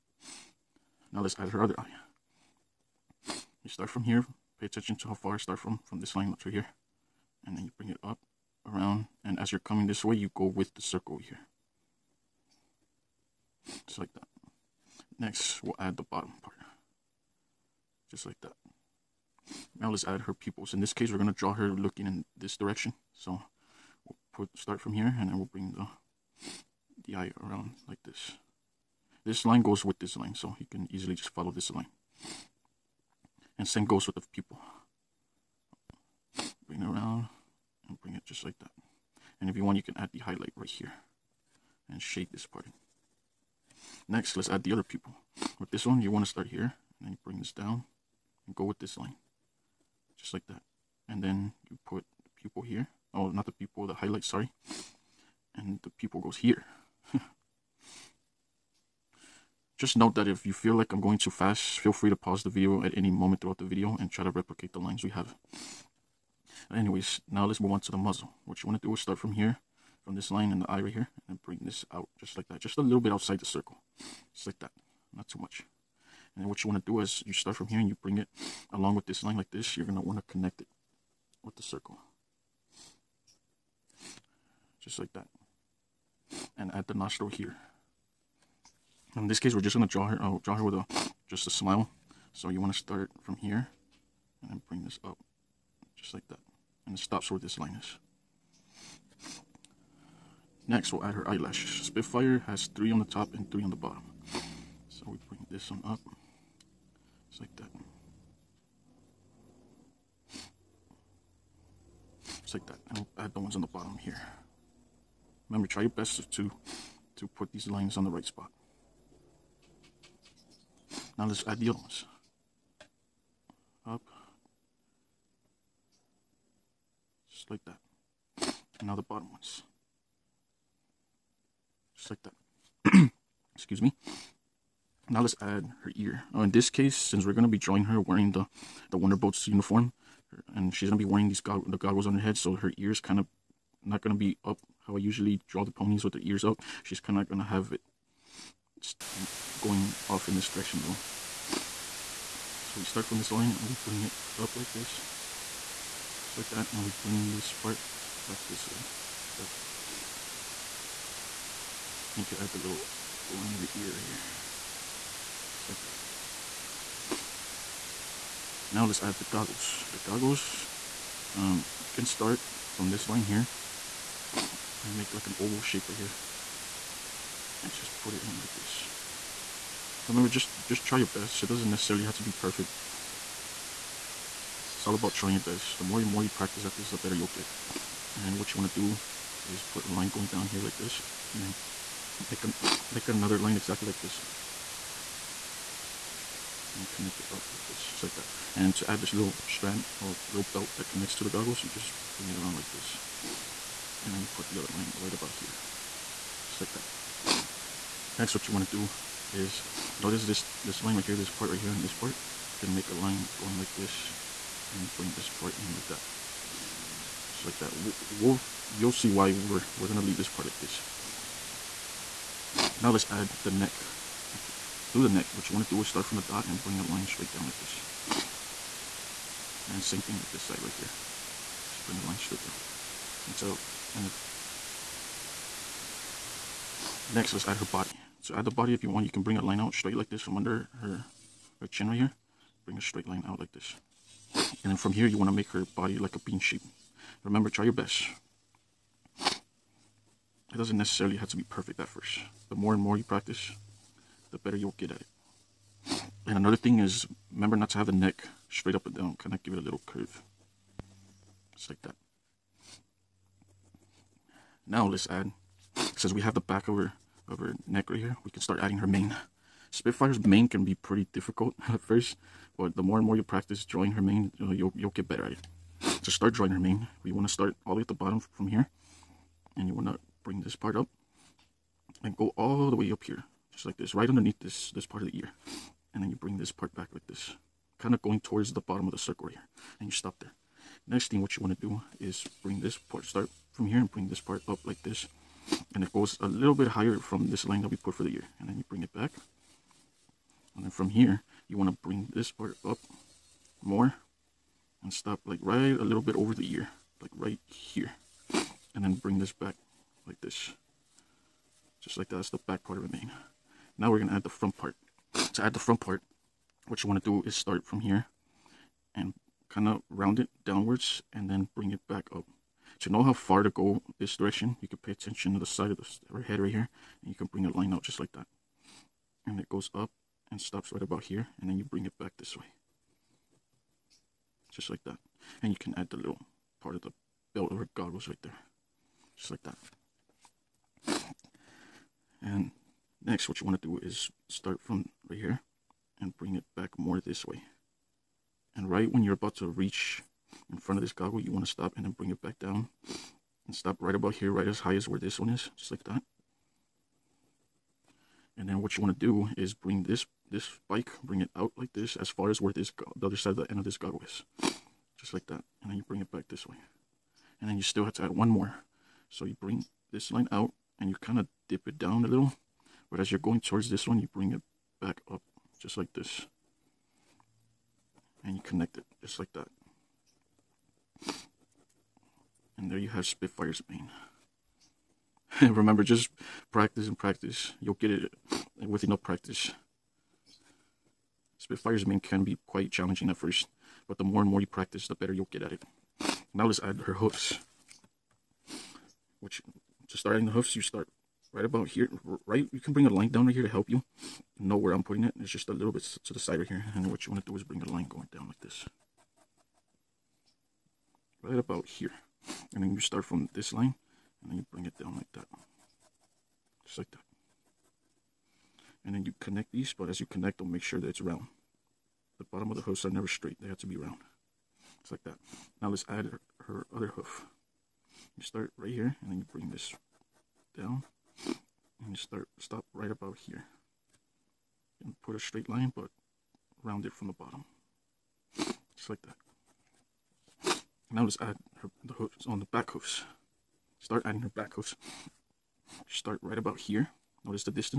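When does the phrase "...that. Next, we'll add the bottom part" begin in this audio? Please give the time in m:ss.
0:14.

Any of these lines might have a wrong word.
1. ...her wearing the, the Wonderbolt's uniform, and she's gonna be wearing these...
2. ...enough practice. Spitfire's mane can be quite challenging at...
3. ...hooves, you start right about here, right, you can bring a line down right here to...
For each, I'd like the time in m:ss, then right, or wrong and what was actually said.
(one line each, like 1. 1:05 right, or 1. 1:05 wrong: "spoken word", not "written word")
1. 2:17 right
2. 6:28 right
3. 6:40 right.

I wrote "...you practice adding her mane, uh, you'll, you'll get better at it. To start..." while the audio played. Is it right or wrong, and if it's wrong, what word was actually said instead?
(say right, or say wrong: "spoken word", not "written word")
wrong: "drawing", not "adding".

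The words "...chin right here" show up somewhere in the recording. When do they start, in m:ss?
4:01.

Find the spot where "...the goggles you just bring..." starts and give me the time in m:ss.
3:21.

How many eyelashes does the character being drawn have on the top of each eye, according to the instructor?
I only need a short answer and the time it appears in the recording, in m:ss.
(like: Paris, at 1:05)
3, at 1:42.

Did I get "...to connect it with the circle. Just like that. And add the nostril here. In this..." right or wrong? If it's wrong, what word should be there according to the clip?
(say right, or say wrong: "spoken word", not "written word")
right.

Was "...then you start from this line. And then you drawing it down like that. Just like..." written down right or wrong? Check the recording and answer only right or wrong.
wrong.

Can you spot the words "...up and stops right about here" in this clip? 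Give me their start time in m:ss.
5:29.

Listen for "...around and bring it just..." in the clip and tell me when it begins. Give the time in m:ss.
0:36.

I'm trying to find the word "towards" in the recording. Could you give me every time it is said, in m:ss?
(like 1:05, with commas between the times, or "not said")
4:48, 6:13.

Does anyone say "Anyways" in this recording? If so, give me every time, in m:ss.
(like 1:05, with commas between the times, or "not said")
1:06.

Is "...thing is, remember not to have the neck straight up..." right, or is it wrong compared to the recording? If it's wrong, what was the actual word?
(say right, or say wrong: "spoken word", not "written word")
right.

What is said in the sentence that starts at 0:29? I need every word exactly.
This line goes with this line, so you can easily just follow this line.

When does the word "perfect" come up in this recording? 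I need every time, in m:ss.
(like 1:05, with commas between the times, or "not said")
3:02, 4:11.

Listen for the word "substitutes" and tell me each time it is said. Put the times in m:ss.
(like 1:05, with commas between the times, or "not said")
not said.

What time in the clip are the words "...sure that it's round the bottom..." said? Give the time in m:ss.
7:00.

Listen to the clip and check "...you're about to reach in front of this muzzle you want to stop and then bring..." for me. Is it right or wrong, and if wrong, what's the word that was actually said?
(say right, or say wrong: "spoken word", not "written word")
wrong: "goggle", not "muzzle".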